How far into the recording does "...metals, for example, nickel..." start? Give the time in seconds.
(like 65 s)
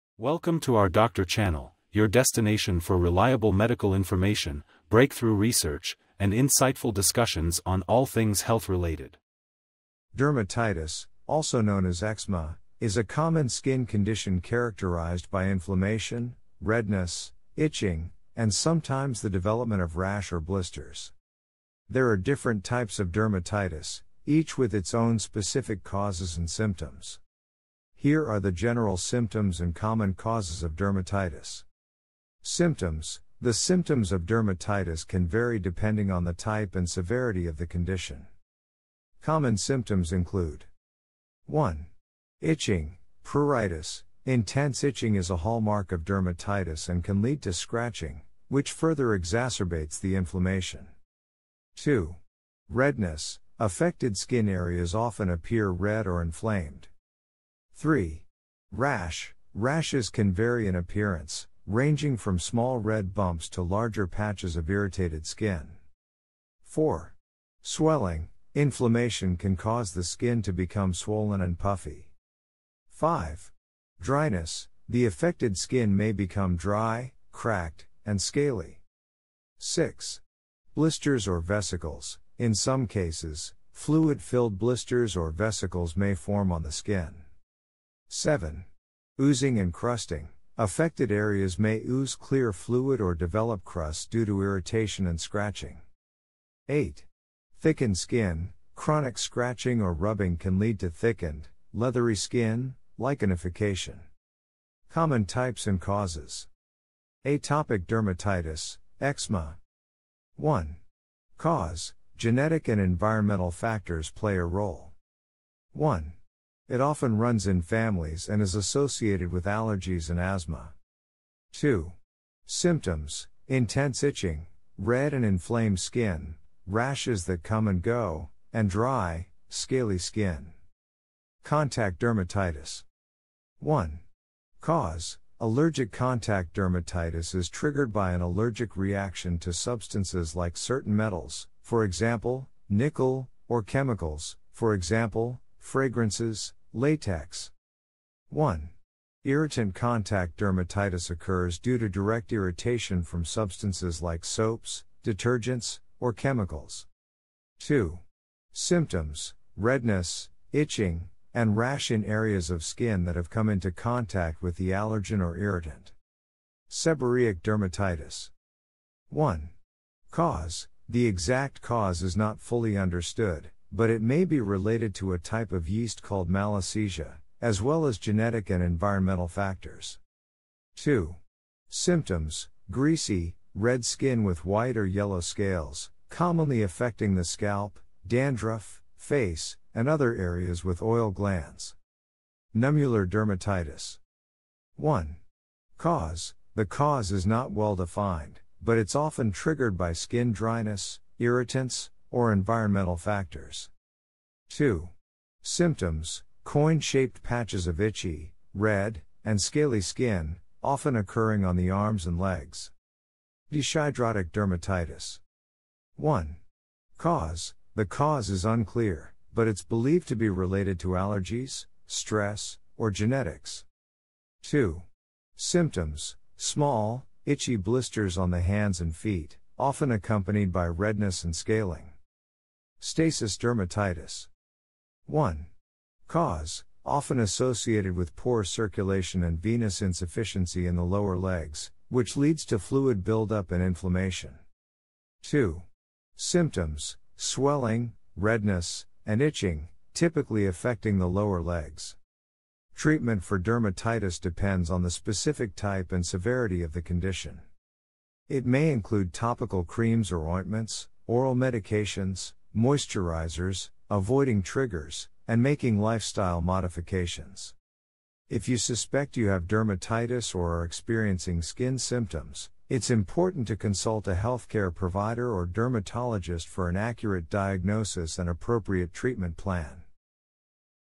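140 s.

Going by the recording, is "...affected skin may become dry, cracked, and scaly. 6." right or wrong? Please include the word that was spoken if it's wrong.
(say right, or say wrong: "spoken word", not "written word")
right.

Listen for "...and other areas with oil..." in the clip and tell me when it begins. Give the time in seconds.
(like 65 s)
189 s.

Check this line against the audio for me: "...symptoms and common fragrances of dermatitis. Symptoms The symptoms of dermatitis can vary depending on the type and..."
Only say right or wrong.
wrong.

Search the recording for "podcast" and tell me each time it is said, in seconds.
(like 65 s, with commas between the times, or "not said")
not said.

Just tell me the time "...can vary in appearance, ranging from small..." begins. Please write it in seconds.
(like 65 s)
60 s.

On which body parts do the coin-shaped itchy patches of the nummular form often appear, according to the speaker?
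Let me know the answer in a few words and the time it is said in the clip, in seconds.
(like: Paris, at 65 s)
arms and legs, at 211 s.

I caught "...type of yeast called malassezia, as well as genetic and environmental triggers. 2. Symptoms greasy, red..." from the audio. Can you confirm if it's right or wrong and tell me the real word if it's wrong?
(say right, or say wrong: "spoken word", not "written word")
wrong: "factors", not "triggers".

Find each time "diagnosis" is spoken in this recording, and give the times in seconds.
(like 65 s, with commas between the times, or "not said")
277 s.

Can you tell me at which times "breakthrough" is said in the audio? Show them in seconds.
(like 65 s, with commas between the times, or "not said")
4 s.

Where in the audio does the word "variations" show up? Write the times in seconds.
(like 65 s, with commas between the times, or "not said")
not said.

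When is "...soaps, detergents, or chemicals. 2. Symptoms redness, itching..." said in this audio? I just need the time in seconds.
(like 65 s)
154 s.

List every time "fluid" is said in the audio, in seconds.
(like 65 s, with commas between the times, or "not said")
83 s, 92 s, 242 s.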